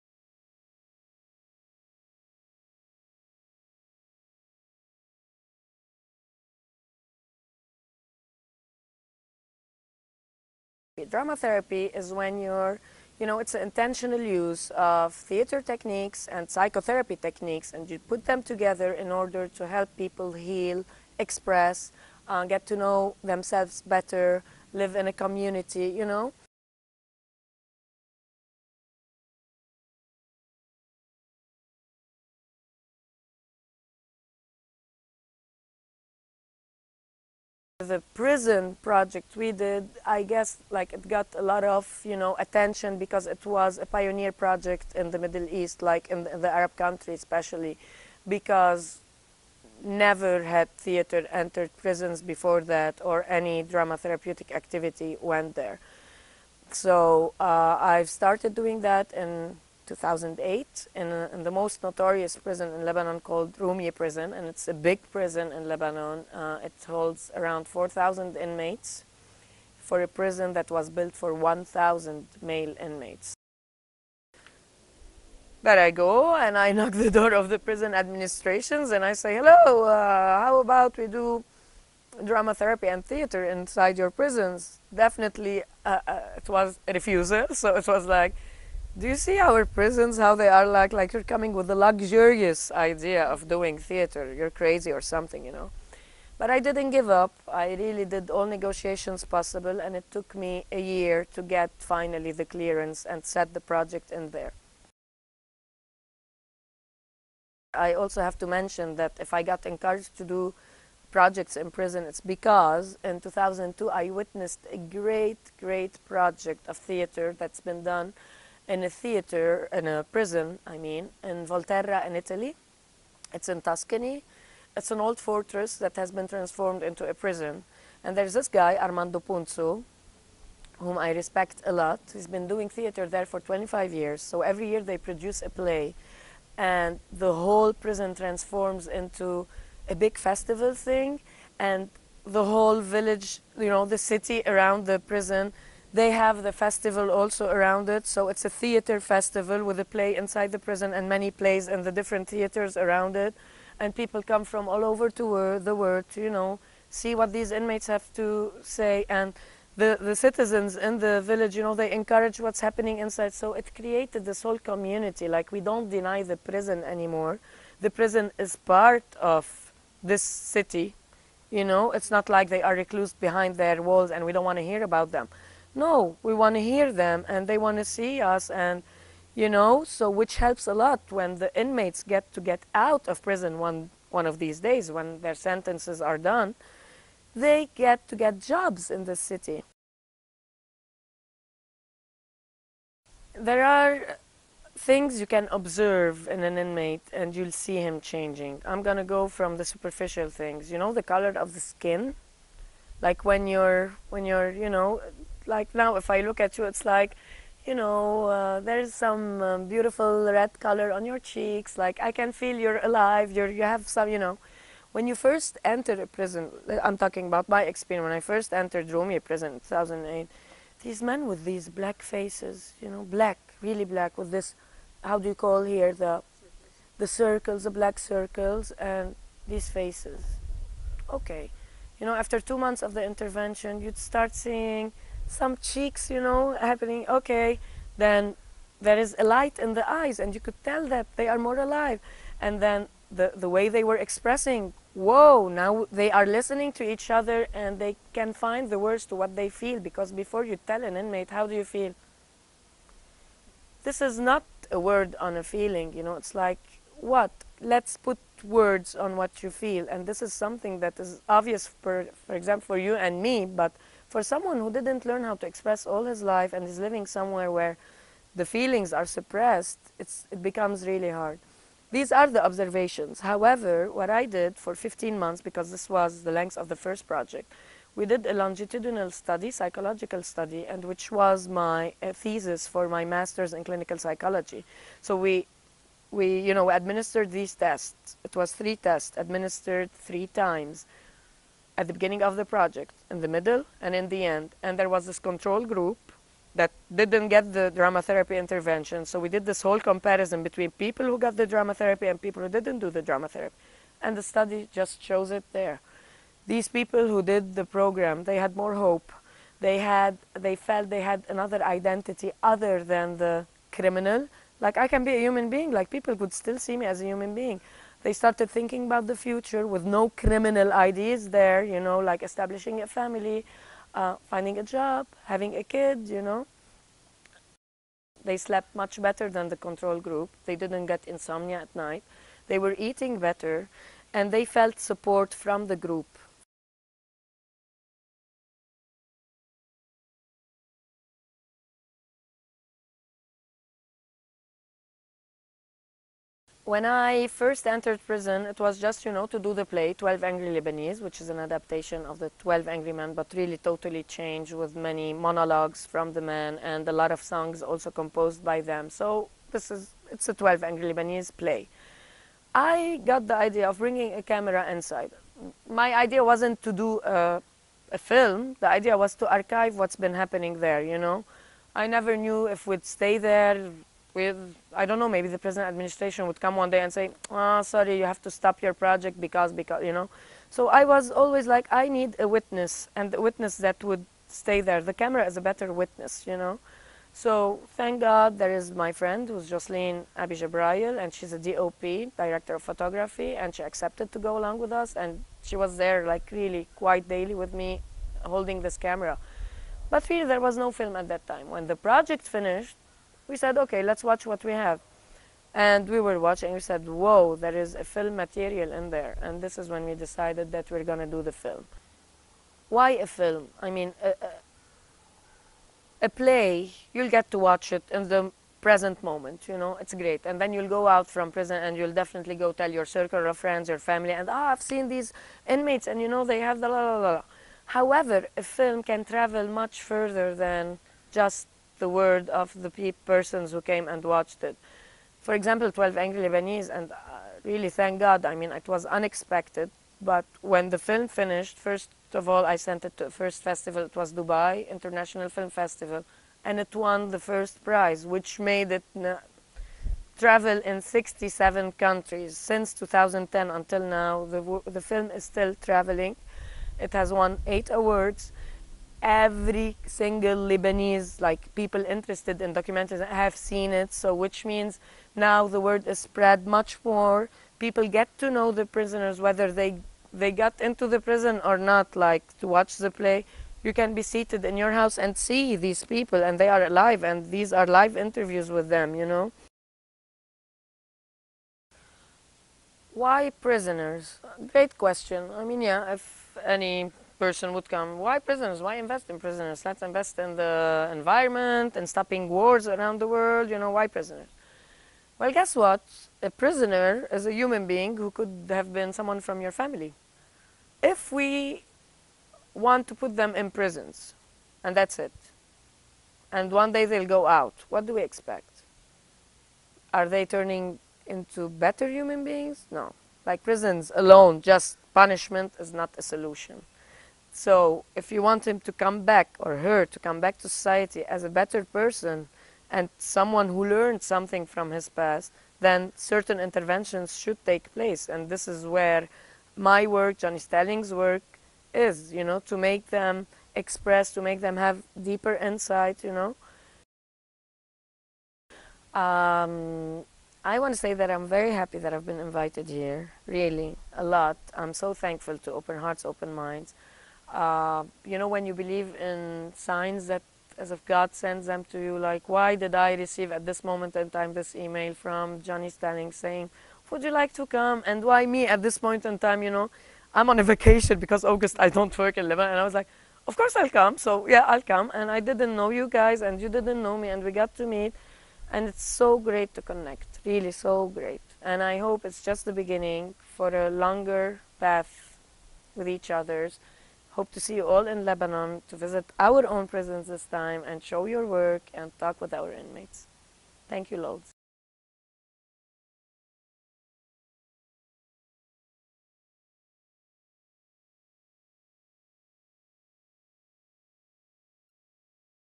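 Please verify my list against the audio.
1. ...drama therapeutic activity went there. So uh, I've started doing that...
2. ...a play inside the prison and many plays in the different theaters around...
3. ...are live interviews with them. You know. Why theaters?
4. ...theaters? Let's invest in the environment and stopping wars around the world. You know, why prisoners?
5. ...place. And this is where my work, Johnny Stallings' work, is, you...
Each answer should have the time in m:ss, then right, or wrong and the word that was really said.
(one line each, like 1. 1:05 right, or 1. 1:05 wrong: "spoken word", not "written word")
1. 0:53 right
2. 2:29 right
3. 7:57 wrong: "prisoners", not "theaters"
4. 8:09 wrong: "prisoners", not "theaters"
5. 8:47 right.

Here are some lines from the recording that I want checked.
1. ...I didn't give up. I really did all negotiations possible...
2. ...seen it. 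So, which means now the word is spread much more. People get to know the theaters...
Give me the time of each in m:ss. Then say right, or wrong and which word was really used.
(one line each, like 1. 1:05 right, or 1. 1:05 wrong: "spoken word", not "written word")
1. 1:36 right
2. 7:43 wrong: "prisoners", not "theaters".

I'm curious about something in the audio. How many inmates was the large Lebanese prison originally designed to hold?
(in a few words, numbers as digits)
1,000.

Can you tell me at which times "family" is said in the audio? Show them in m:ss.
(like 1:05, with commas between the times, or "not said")
5:22, 7:03, 8:19.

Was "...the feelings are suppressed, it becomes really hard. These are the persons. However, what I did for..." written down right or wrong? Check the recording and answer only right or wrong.
wrong.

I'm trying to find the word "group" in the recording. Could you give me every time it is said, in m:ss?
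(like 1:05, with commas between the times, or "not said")
4:55, 5:29, 5:35.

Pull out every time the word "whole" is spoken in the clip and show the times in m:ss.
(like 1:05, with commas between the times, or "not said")
2:17, 2:22, 2:44, 4:59.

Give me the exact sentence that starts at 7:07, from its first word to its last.
However, a film can travel much further than just the word of the pe persons who came and watched it.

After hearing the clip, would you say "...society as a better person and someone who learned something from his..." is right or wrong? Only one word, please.
right.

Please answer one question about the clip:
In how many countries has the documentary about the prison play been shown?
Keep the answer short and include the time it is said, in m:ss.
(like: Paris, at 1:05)
67, at 7:30.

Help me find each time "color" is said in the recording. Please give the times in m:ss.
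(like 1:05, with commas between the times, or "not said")
3:21, 3:30.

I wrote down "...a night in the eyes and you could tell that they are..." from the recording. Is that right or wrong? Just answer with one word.
wrong.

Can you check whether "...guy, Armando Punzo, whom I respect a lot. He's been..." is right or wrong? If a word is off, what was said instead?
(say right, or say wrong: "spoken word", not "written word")
right.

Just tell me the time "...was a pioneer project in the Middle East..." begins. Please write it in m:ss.
0:43.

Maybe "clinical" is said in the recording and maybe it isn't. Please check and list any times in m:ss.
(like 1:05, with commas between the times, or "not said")
4:43.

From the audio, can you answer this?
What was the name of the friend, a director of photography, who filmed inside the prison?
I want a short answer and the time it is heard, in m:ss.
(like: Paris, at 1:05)
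Jocelyn Abi Gebrayel, at 6:29.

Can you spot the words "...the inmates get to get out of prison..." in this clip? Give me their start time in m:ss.
3:01.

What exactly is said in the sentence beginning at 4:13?
This is not a word on a feeling, you know, it's like, what?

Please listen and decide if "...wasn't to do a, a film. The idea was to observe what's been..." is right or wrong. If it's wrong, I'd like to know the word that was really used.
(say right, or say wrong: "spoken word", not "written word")
wrong: "archive", not "observe".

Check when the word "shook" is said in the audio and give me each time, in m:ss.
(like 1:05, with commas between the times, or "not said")
not said.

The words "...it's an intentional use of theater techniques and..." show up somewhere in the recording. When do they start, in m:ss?
0:13.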